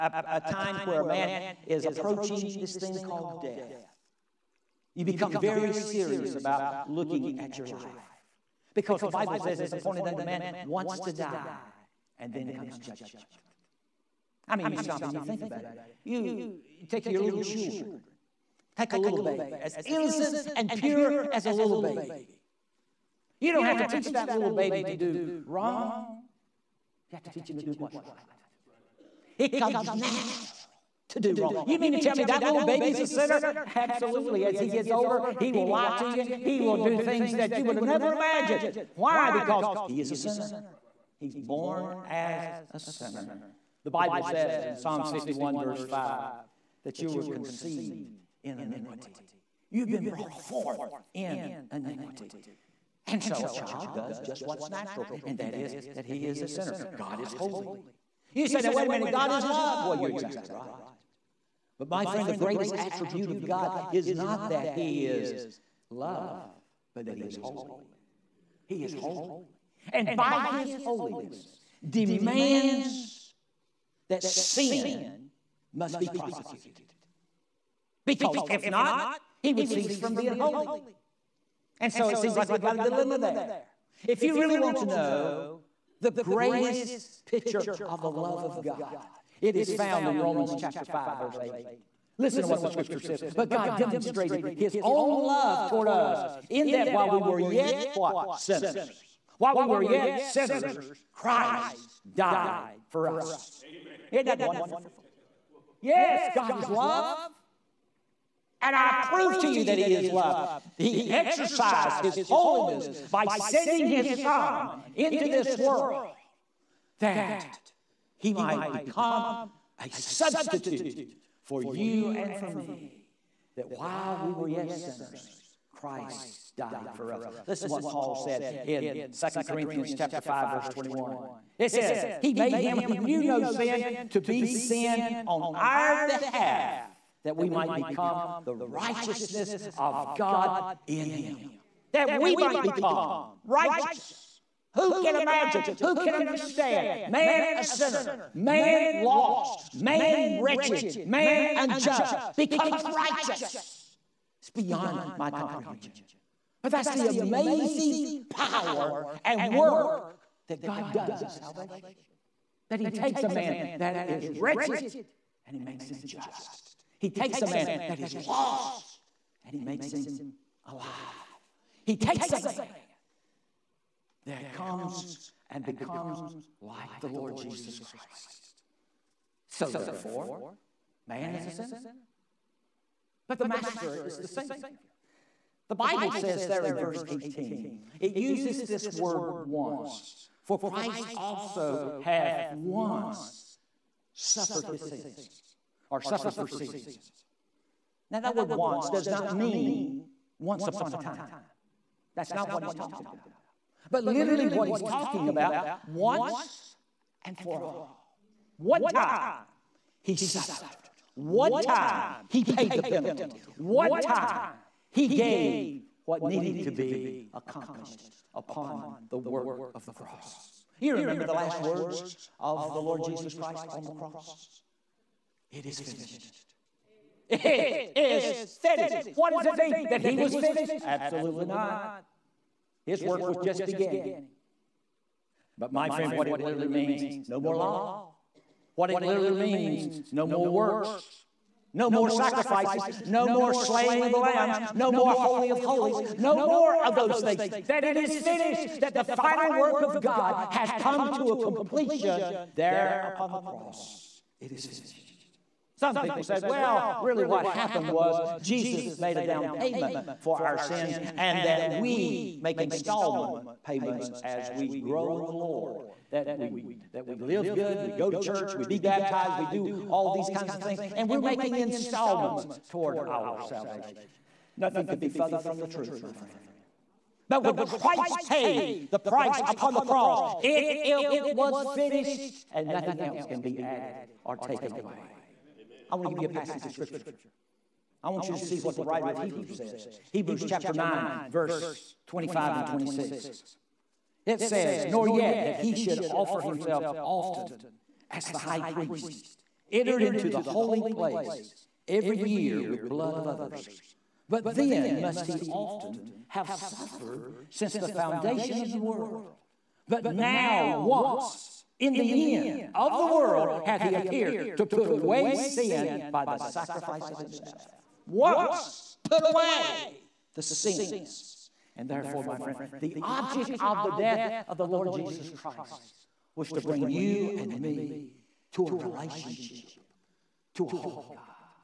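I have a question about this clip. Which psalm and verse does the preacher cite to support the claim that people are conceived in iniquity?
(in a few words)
Psalms 51:5.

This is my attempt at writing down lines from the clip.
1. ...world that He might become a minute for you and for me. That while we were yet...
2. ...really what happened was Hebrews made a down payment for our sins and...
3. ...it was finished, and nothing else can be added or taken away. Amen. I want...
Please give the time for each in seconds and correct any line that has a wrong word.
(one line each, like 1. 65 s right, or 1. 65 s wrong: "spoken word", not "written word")
1. 115 s wrong: "substitute", not "minute"
2. 256 s wrong: "Jesus", not "Hebrews"
3. 281 s right.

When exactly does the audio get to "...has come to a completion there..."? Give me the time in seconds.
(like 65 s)
250 s.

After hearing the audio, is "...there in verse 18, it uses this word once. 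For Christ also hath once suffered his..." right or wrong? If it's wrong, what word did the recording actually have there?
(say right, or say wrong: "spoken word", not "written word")
right.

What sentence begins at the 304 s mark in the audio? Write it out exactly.
But then must he often have suffered since the foundation of the world.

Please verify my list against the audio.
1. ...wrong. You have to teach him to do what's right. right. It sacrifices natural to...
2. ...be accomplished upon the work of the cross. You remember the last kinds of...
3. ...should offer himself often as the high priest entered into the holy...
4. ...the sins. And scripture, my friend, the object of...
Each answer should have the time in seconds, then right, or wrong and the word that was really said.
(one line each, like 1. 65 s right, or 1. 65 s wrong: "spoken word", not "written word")
1. 25 s wrong: "comes", not "sacrifices"
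2. 216 s wrong: "words", not "kinds"
3. 295 s right
4. 320 s wrong: "therefore", not "scripture".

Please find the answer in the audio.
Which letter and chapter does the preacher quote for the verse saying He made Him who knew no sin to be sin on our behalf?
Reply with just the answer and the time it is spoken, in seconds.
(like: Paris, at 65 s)
2 Corinthians 5:21, at 129 s.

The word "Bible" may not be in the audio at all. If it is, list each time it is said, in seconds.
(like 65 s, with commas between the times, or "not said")
9 s, 43 s, 185 s.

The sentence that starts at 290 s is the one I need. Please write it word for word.
Hebrews chapter 9, verse 25 and 26.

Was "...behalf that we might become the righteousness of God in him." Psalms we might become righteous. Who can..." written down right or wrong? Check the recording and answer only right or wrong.
wrong.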